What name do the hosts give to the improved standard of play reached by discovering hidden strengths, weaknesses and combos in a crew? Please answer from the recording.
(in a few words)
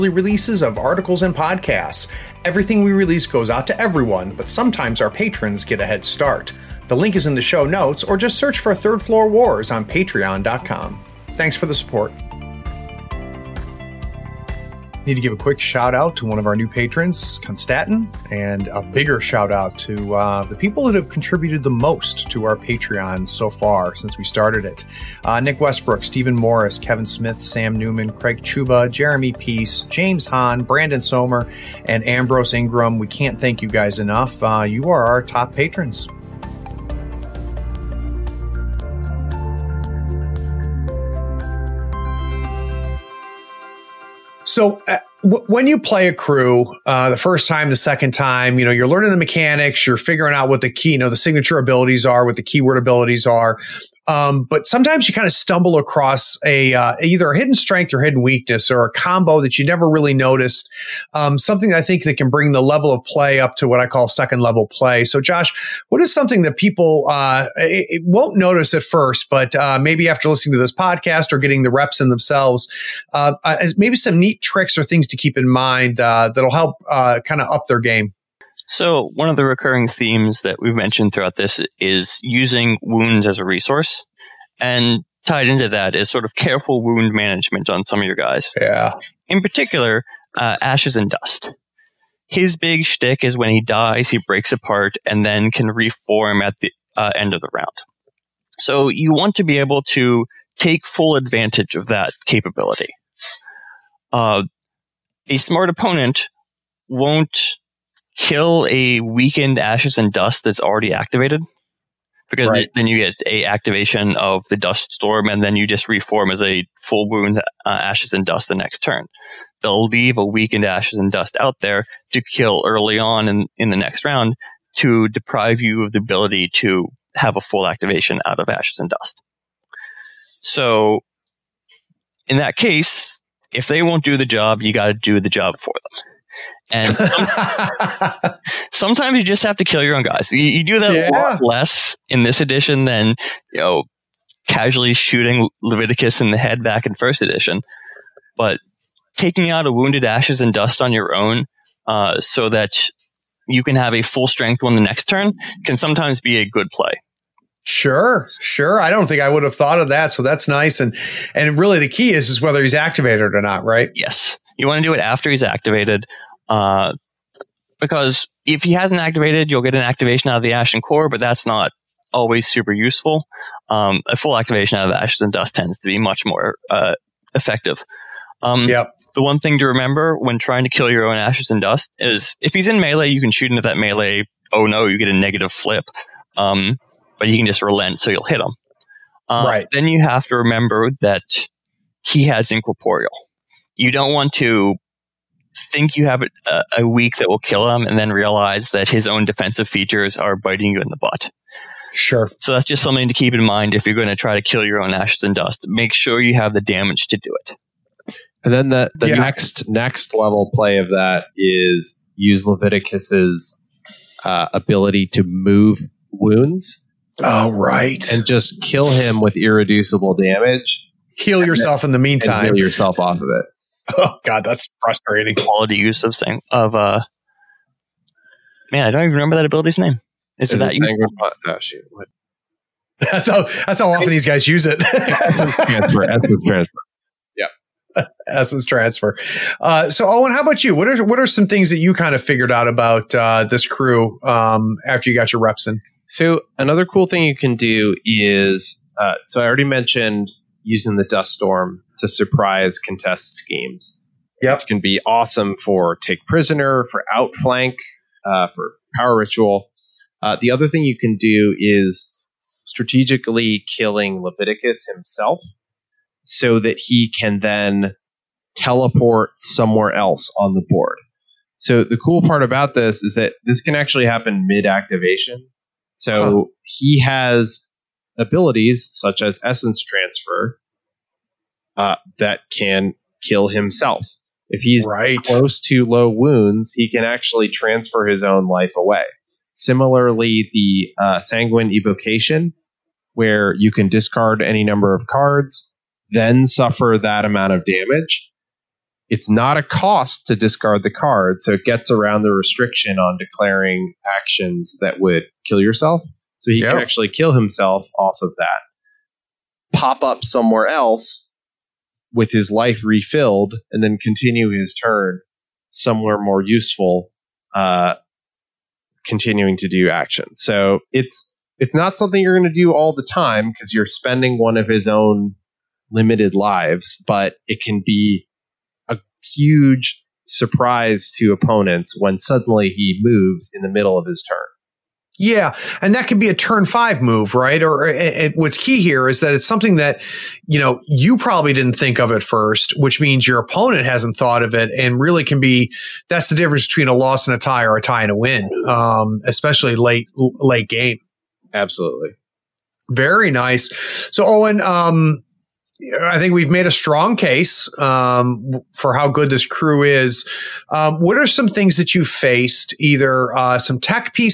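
second level play.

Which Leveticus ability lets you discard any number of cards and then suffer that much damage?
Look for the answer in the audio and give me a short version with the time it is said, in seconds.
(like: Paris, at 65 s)
sanguine evocation, at 291 s.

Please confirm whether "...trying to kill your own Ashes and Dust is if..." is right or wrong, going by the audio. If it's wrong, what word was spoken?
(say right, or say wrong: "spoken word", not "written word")
right.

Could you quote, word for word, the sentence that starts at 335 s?
Yeah, and that could be a turn five move, right?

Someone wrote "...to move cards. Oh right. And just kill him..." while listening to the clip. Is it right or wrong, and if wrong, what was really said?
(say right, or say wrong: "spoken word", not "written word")
wrong: "wounds", not "cards".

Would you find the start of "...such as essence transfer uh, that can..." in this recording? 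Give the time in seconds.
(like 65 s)
278 s.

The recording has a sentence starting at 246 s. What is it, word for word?
So, another cool thing you can do is uh, so I already mentioned using the dust storm to surprise contest schemes.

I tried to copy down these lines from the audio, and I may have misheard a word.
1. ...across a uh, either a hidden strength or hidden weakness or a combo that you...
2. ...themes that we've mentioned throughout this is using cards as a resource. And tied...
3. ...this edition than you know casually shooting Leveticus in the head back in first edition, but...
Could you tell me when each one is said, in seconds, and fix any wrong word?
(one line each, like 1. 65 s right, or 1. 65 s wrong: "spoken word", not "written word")
1. 55 s right
2. 79 s wrong: "wounds", not "cards"
3. 142 s right.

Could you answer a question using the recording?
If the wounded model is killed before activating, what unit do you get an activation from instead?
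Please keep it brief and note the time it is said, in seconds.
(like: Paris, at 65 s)
Ashen Core, at 170 s.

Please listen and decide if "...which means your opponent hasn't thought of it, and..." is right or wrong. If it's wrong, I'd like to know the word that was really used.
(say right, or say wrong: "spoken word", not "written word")
right.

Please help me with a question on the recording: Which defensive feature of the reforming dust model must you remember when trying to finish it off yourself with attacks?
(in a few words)
incorporeal.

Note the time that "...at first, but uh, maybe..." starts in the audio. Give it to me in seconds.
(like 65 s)
68 s.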